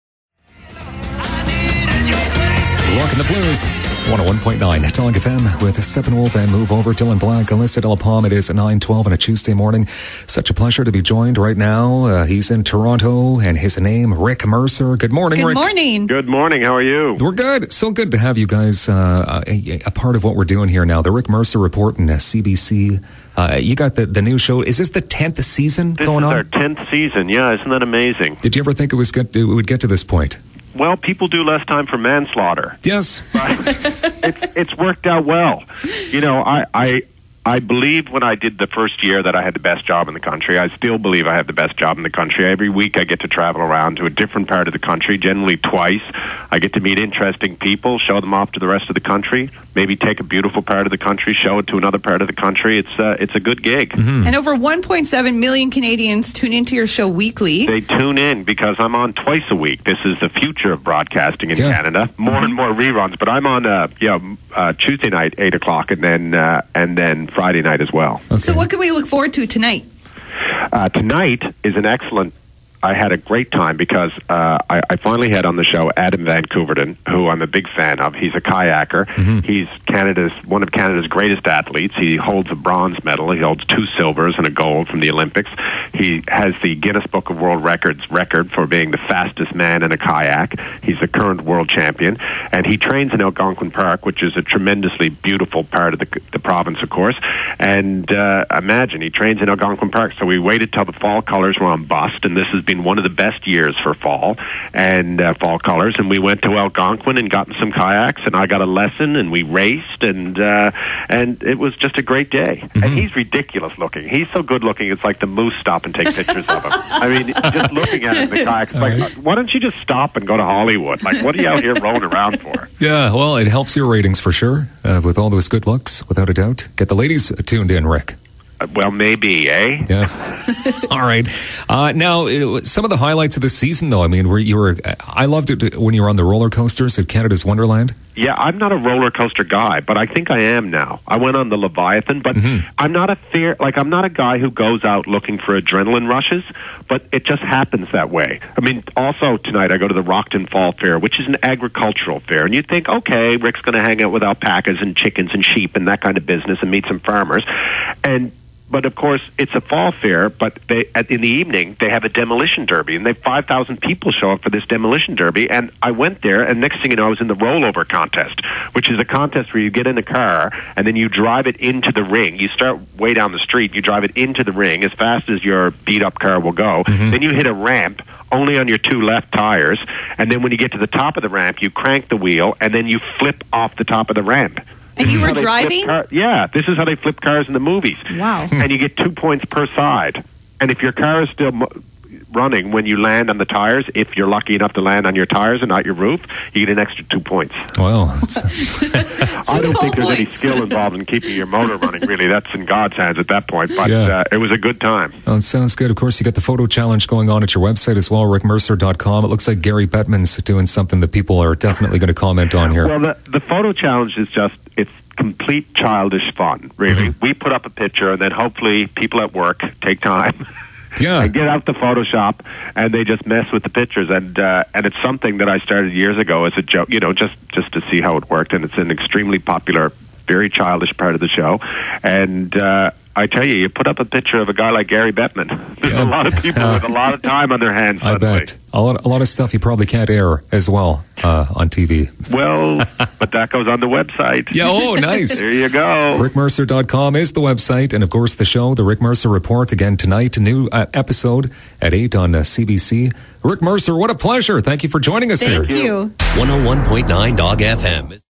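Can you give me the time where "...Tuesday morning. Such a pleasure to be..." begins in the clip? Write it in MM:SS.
00:09.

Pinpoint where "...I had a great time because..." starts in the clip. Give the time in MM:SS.
01:12.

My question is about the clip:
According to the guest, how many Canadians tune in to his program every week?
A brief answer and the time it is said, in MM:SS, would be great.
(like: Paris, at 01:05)
1.7 million, at 00:54.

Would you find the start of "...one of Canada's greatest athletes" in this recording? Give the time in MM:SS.
01:20.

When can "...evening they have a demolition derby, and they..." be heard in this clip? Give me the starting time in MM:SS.
02:41.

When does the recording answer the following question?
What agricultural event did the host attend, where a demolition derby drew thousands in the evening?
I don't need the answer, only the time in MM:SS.
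02:30.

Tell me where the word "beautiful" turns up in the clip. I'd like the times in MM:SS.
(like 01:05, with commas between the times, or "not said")
00:50, 01:35.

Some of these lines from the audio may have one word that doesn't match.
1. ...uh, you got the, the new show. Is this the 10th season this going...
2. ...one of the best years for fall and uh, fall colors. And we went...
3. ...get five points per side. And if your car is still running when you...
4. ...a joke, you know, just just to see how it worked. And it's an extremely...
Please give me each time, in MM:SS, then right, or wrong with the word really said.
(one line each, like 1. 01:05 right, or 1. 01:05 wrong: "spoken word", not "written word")
1. 00:23 right
2. 01:42 right
3. 03:08 wrong: "two", not "five"
4. 03:46 right.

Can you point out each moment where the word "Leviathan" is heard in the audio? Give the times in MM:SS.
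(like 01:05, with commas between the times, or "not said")
02:21.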